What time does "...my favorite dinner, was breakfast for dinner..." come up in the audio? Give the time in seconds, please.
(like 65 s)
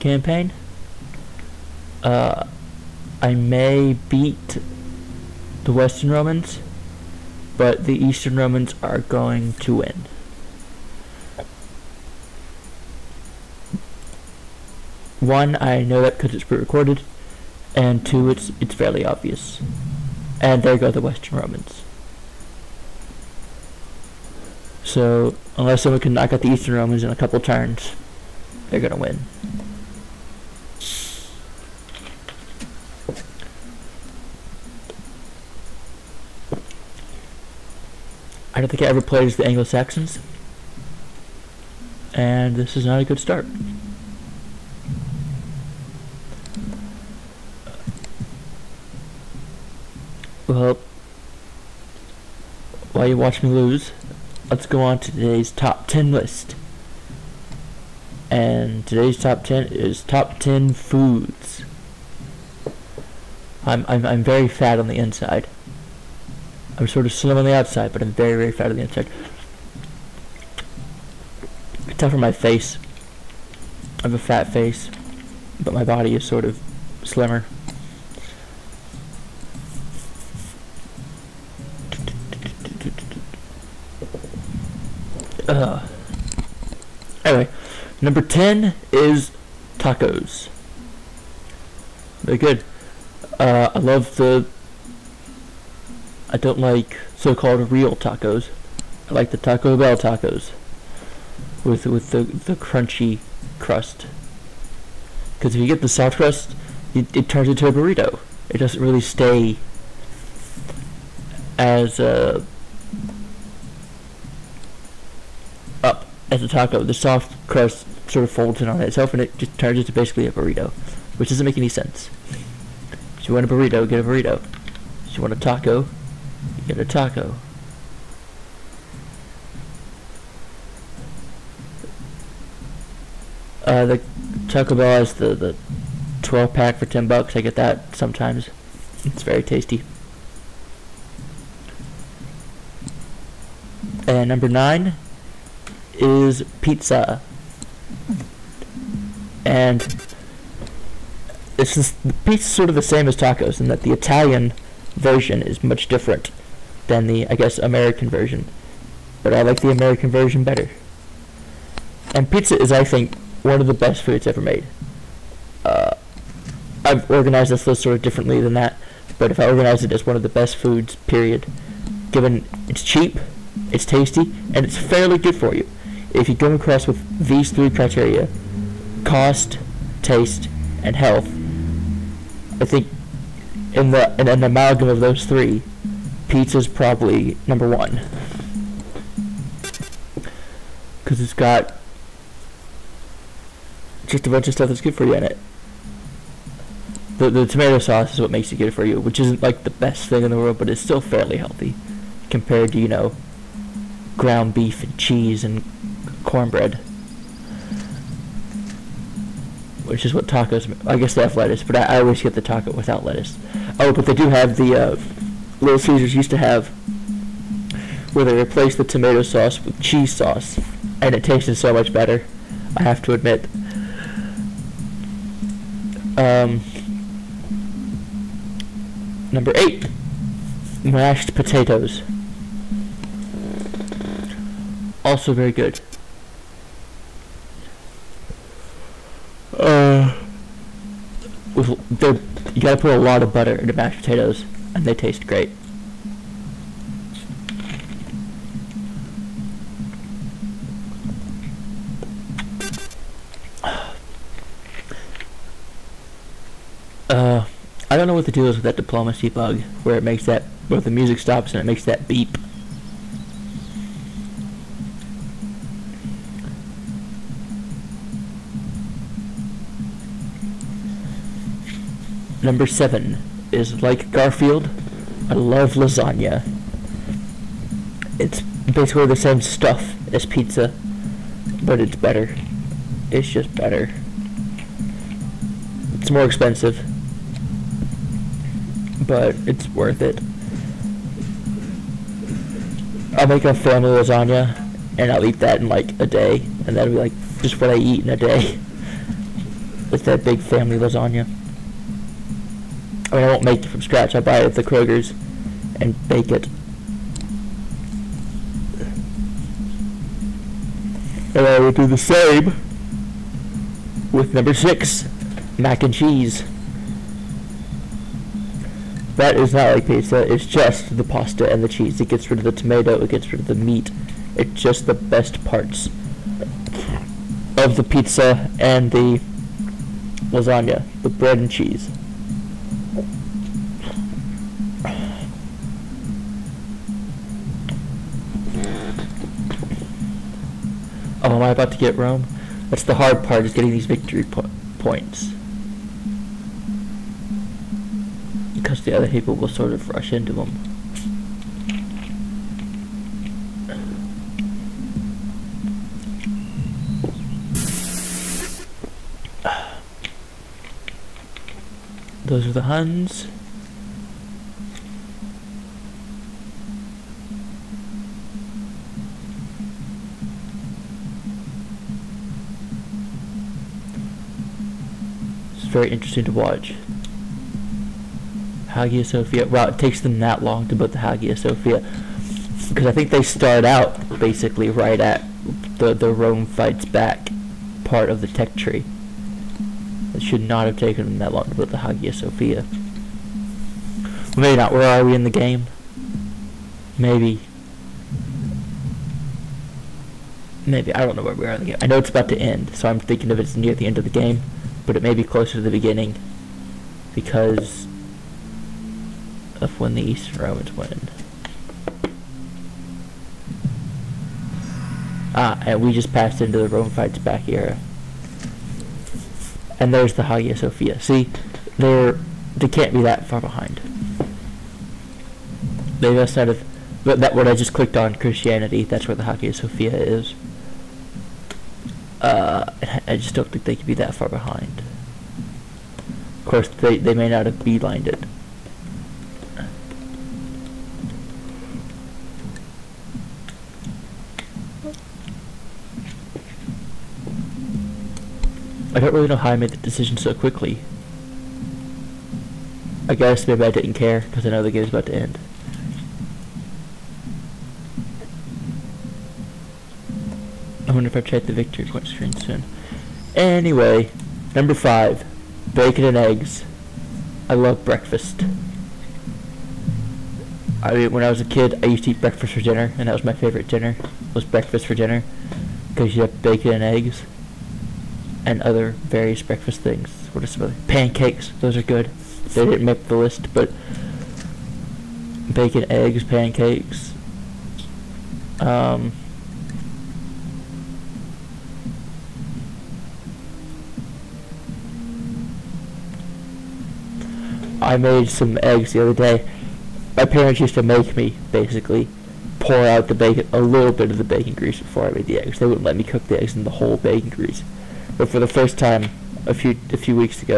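473 s.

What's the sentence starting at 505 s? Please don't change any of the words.
They wouldn't let me cook the eggs in the whole bacon grease.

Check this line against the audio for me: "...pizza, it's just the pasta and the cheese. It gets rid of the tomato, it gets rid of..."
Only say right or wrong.
right.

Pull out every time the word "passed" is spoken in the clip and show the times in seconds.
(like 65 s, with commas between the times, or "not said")
416 s.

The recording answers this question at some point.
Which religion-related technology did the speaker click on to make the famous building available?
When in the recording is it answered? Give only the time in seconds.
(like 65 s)
428 s.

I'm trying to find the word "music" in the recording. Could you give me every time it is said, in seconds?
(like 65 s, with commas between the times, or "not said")
260 s.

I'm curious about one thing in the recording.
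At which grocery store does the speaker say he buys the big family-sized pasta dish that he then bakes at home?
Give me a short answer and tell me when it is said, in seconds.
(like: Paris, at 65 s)
Kroger's, at 304 s.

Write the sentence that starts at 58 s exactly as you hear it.
And today's top 10 is top 10 foods.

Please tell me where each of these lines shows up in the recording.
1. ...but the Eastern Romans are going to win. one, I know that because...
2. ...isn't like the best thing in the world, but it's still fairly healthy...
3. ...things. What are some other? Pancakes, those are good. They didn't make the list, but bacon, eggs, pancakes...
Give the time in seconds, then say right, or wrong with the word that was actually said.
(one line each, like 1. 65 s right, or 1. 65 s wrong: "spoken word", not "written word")
1. 7 s right
2. 199 s right
3. 479 s right.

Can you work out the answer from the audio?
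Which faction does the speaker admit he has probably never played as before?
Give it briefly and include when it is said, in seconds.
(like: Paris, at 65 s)
Anglo-Saxons, at 39 s.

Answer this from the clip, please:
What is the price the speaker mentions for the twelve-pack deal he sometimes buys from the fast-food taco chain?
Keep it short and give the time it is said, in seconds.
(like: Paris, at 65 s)
10 bucks, at 136 s.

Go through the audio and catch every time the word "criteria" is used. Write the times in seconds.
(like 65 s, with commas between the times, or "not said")
177 s.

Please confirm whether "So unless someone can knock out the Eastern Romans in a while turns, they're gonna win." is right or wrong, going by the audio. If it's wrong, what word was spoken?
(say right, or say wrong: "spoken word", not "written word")
wrong: "couple", not "while".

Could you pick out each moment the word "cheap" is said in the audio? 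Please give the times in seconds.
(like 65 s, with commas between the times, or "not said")
172 s.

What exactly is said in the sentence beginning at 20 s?
And there go the Western Romans.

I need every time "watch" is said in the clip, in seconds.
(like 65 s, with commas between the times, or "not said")
53 s, 376 s.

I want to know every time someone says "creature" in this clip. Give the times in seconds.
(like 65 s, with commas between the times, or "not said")
not said.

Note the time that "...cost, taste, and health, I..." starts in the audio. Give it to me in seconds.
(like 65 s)
179 s.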